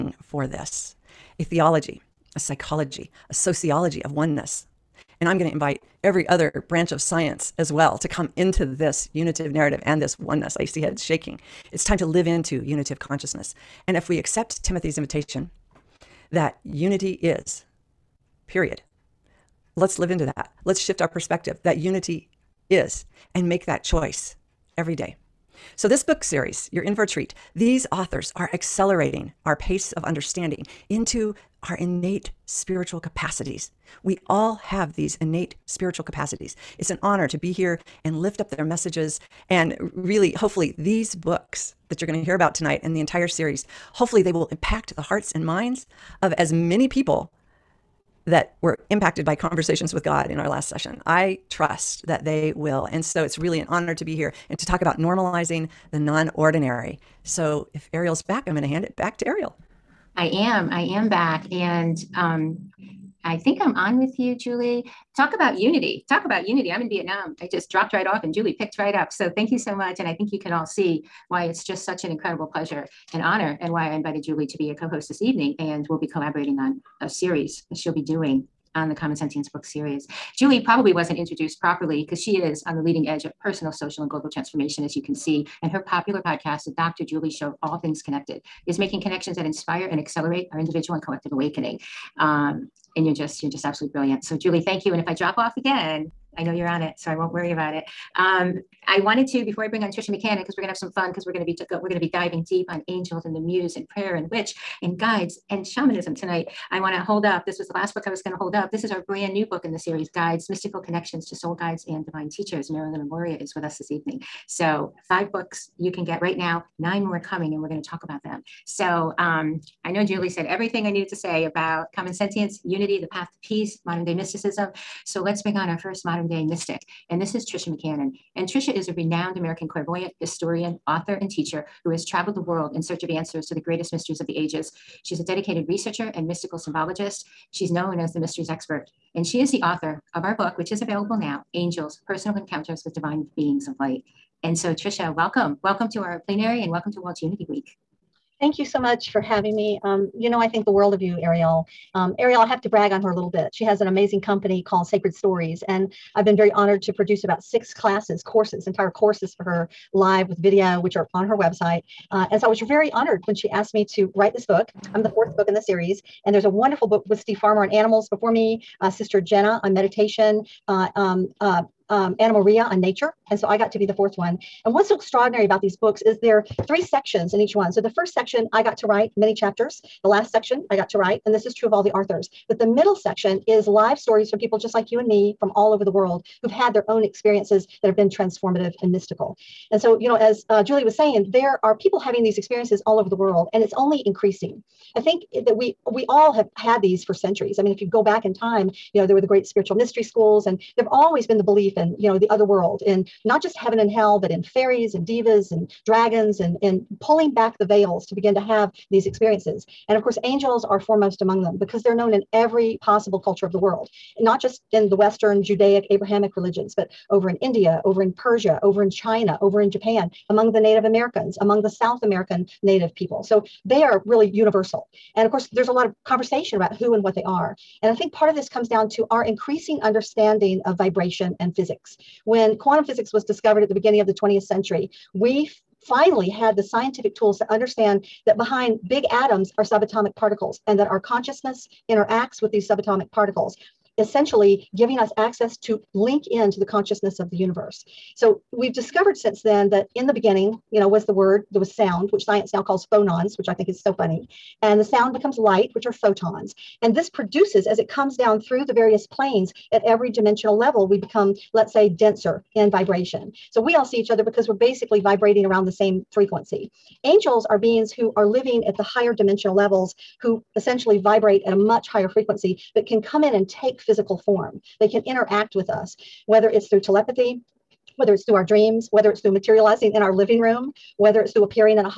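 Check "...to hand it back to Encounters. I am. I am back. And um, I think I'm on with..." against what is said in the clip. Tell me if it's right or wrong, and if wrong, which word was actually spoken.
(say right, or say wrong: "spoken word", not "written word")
wrong: "Ariel", not "Encounters".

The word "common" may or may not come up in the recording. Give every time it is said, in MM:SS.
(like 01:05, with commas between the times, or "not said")
01:18, 02:01.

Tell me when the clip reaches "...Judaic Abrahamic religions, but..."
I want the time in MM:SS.
03:35.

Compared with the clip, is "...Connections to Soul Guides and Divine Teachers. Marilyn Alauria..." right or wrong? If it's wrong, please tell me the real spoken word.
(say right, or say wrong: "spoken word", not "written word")
right.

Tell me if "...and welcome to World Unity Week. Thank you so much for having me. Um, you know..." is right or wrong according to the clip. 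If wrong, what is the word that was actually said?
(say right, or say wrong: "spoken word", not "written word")
right.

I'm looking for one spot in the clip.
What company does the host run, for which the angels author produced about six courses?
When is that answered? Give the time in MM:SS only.
02:34.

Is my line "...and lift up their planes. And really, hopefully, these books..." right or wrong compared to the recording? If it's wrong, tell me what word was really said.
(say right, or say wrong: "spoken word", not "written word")
wrong: "messages", not "planes".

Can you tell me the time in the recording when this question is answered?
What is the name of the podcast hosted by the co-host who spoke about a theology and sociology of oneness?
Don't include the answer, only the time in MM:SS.
01:26.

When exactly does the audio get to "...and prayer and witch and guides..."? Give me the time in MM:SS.
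01:43.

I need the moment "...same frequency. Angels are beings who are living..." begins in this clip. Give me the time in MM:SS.
04:25.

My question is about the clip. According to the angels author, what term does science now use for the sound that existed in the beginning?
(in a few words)
phonons.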